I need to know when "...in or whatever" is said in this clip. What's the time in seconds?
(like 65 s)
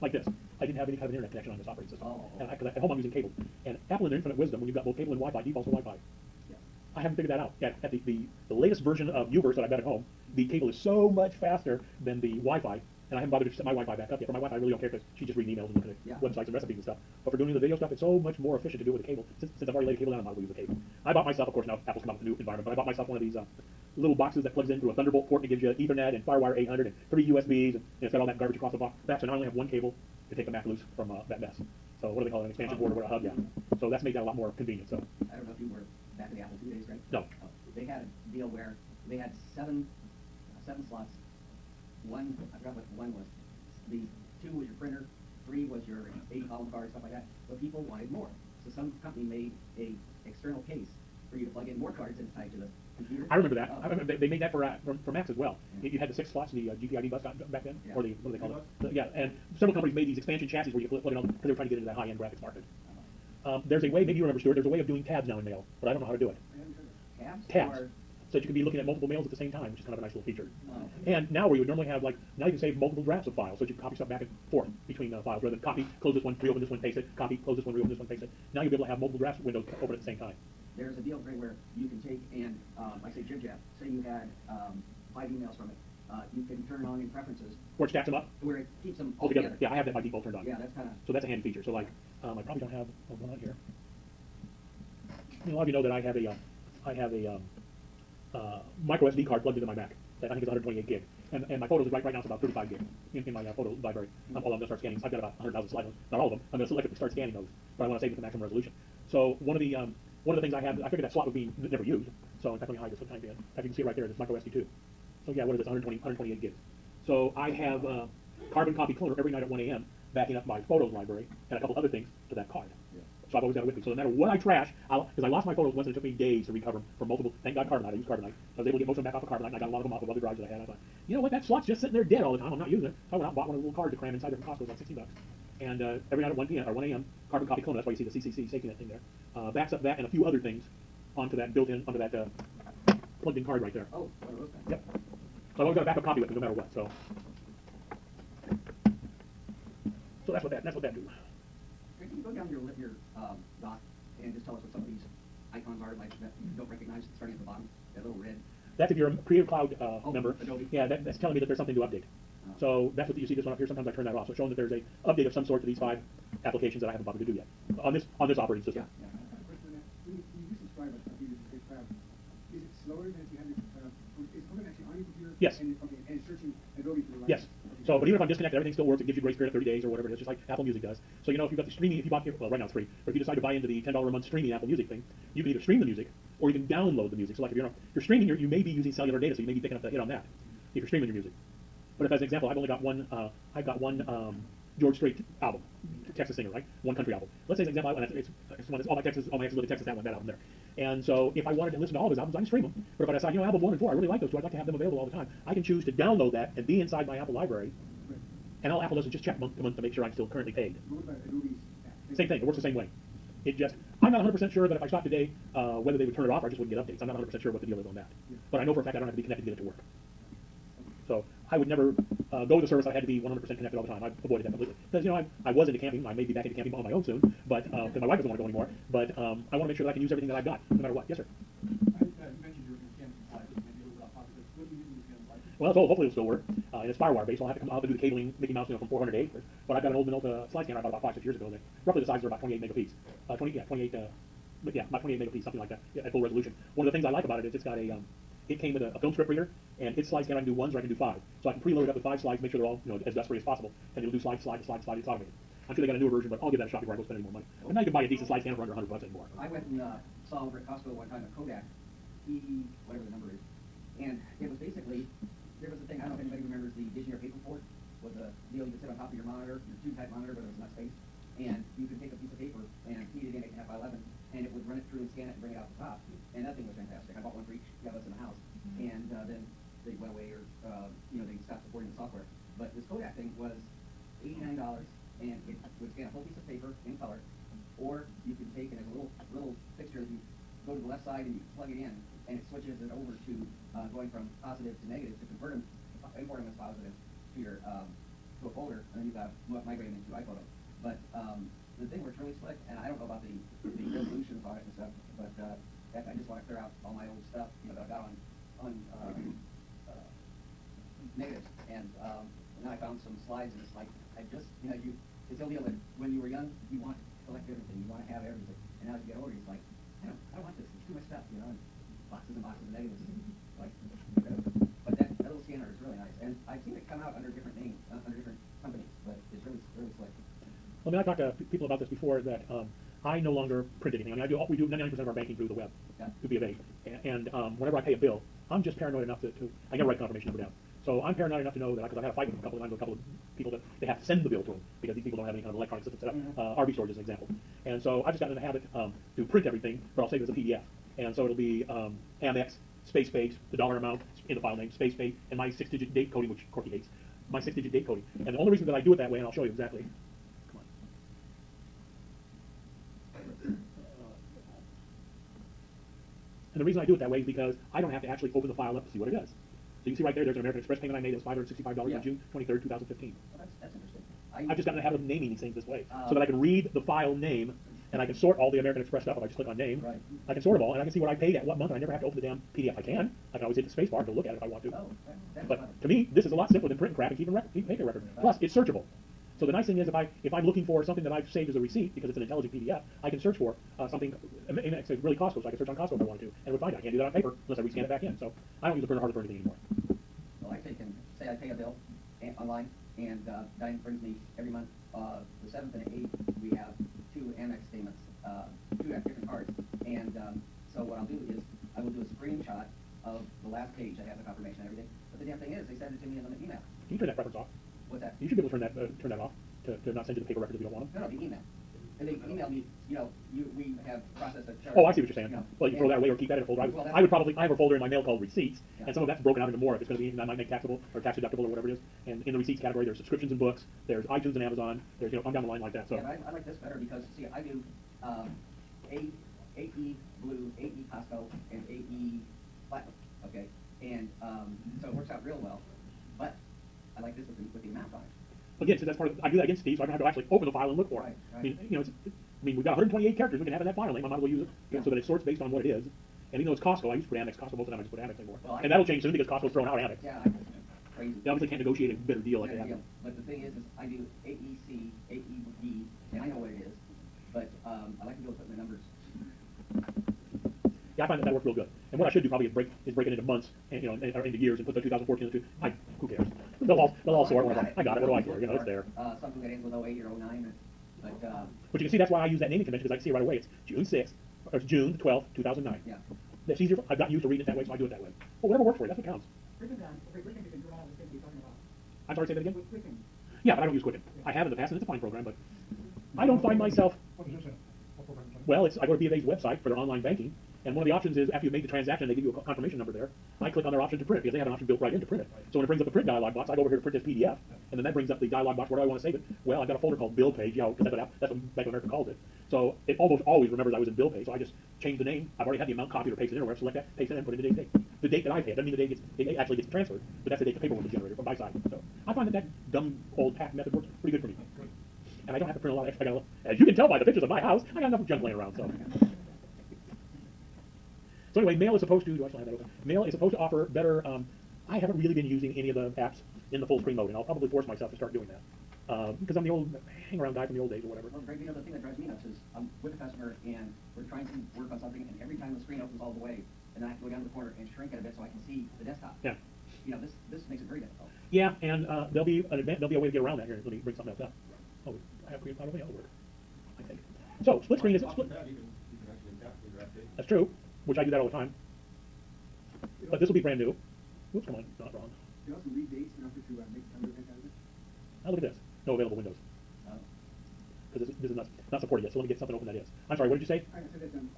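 516 s.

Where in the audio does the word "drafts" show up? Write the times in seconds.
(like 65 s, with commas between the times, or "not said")
73 s, 79 s.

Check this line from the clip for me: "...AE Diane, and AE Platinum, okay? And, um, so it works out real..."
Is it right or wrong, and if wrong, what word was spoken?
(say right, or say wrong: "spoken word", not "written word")
wrong: "Costco", not "Diane".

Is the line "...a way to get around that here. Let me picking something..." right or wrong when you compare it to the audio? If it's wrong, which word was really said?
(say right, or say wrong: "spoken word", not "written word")
wrong: "bring", not "picking".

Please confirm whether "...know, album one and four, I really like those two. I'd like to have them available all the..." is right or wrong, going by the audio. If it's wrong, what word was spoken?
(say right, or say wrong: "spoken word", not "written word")
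right.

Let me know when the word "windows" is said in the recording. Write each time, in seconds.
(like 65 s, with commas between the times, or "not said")
79 s, 569 s.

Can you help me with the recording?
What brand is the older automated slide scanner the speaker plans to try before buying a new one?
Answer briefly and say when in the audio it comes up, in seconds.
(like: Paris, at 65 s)
Minolta, at 240 s.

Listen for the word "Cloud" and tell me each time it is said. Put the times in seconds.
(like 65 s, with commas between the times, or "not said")
159 s, 555 s.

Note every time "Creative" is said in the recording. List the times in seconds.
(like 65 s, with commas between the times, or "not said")
159 s, 555 s.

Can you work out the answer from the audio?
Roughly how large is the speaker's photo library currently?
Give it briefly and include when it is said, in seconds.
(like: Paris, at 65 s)
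35 gig, at 102 s.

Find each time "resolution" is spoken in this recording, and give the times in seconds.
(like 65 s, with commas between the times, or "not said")
108 s, 246 s, 303 s.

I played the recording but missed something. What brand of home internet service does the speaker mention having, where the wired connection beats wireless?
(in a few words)
Uverse.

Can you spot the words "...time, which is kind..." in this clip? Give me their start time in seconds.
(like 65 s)
69 s.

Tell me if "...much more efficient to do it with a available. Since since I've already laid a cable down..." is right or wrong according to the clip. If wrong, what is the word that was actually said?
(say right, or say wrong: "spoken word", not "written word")
wrong: "cable", not "available".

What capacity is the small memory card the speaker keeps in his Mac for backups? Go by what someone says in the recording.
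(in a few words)
128 gigs.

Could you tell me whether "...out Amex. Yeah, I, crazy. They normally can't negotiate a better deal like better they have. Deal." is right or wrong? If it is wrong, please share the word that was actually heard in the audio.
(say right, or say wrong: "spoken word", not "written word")
wrong: "obviously", not "normally".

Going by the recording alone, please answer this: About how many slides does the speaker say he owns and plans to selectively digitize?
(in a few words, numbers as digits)
100,000.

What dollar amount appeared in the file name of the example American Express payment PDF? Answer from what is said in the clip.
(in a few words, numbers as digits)
$565.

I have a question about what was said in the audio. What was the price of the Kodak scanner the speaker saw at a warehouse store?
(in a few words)
$89.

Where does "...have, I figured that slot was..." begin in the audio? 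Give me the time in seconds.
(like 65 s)
110 s.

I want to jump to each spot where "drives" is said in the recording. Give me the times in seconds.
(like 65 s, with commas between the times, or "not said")
130 s, 541 s.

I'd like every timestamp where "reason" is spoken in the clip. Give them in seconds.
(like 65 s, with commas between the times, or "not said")
358 s, 366 s.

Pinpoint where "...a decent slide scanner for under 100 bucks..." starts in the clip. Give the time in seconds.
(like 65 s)
258 s.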